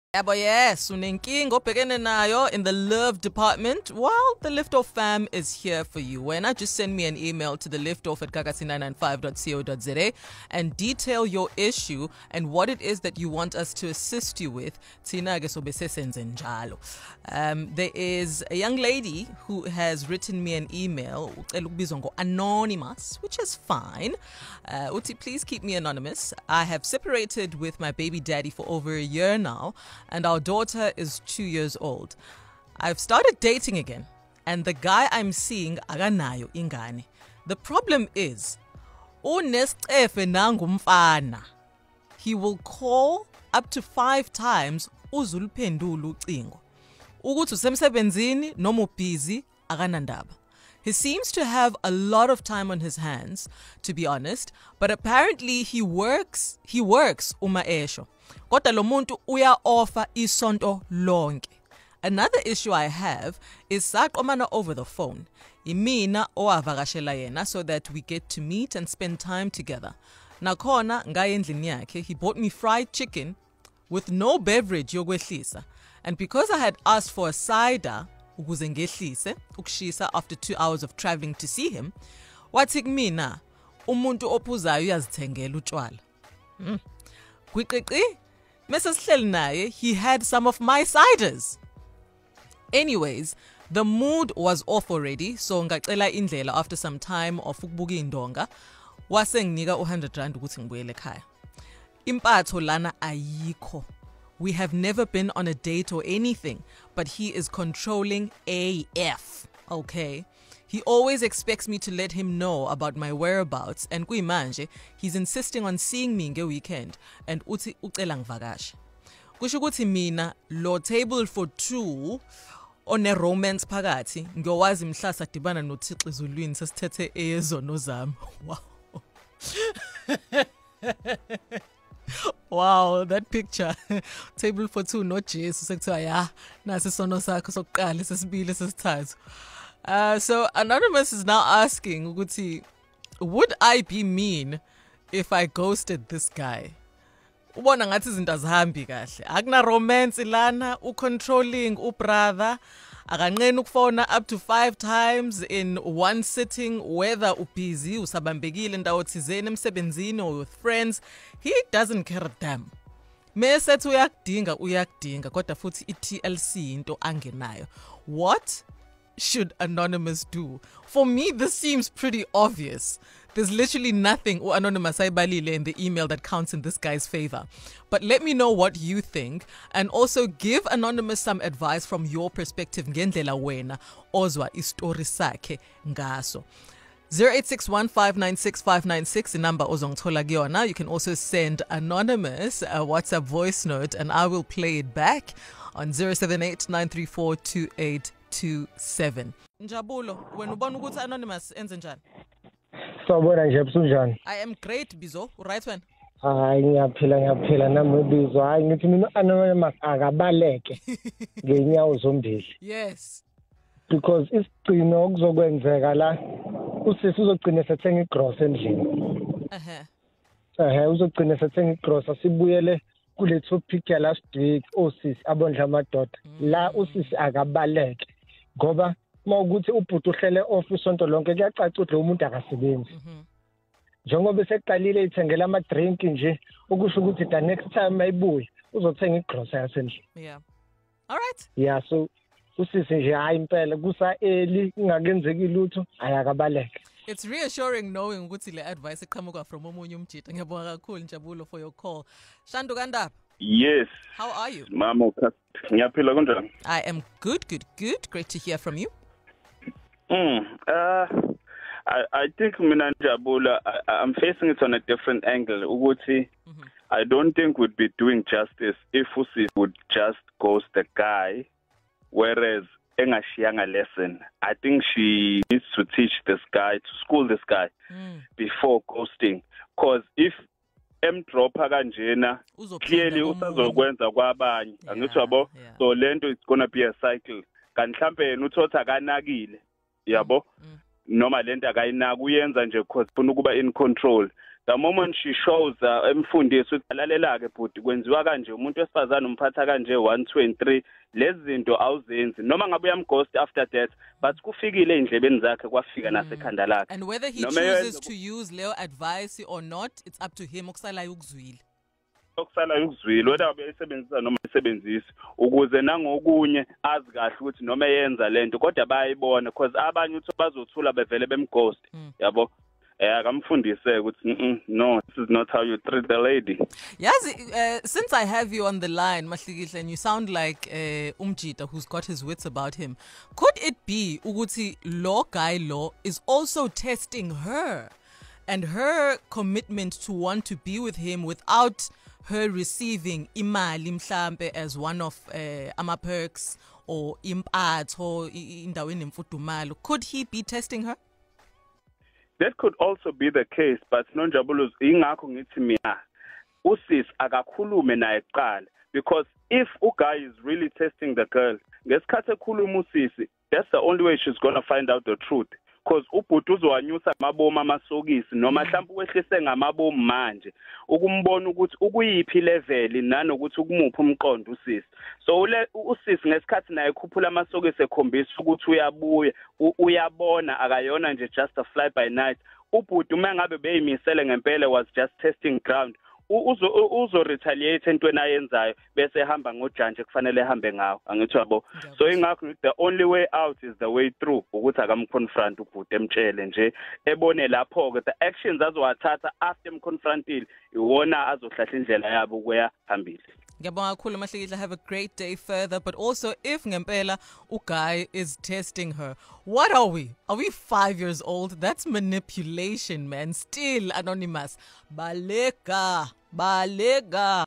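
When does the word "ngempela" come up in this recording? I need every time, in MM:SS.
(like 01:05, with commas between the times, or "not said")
06:24, 06:46.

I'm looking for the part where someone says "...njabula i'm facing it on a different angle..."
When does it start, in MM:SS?
04:22.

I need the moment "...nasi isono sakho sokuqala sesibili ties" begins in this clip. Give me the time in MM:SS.
02:16.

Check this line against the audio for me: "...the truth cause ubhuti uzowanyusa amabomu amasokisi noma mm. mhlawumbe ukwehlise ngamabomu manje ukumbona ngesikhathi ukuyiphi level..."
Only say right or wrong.
wrong.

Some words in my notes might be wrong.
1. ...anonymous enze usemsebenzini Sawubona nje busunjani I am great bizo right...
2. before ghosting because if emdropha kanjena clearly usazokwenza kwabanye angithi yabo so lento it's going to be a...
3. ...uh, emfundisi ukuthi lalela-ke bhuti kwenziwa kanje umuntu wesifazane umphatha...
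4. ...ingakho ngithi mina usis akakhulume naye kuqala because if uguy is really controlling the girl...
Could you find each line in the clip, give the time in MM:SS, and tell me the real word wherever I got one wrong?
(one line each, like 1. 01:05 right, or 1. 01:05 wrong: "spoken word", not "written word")
1. 03:20 wrong: "njani", not "usemsebenzini"
2. 04:38 right
3. 04:55 right
4. 05:54 wrong: "testing", not "controlling".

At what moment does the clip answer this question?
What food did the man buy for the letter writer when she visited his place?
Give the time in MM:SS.
01:12.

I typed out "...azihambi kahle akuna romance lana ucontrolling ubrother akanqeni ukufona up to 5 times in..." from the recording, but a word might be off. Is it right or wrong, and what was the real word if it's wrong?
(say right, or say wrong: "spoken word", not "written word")
right.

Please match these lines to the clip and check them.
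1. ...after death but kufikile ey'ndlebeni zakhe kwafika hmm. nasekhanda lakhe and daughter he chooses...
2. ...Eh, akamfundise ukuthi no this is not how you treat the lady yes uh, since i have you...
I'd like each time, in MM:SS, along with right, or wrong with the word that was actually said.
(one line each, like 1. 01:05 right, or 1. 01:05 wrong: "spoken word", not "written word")
1. 05:03 wrong: "whether", not "daughter"
2. 05:23 right.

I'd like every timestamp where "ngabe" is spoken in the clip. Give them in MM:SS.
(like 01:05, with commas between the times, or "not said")
05:02, 06:23.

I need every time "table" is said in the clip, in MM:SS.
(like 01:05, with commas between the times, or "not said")
02:00, 02:14.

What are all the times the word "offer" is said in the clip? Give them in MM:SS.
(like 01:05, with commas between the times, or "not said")
00:59.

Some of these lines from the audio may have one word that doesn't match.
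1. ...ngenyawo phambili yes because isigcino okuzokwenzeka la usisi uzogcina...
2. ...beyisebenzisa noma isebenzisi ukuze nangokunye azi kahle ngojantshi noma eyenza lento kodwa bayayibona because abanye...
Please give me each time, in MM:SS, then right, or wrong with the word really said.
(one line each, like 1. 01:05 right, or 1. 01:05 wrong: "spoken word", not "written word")
1. 03:31 wrong: "zombili", not "phambili"
2. 05:13 wrong: "ukuthi", not "ngojantshi".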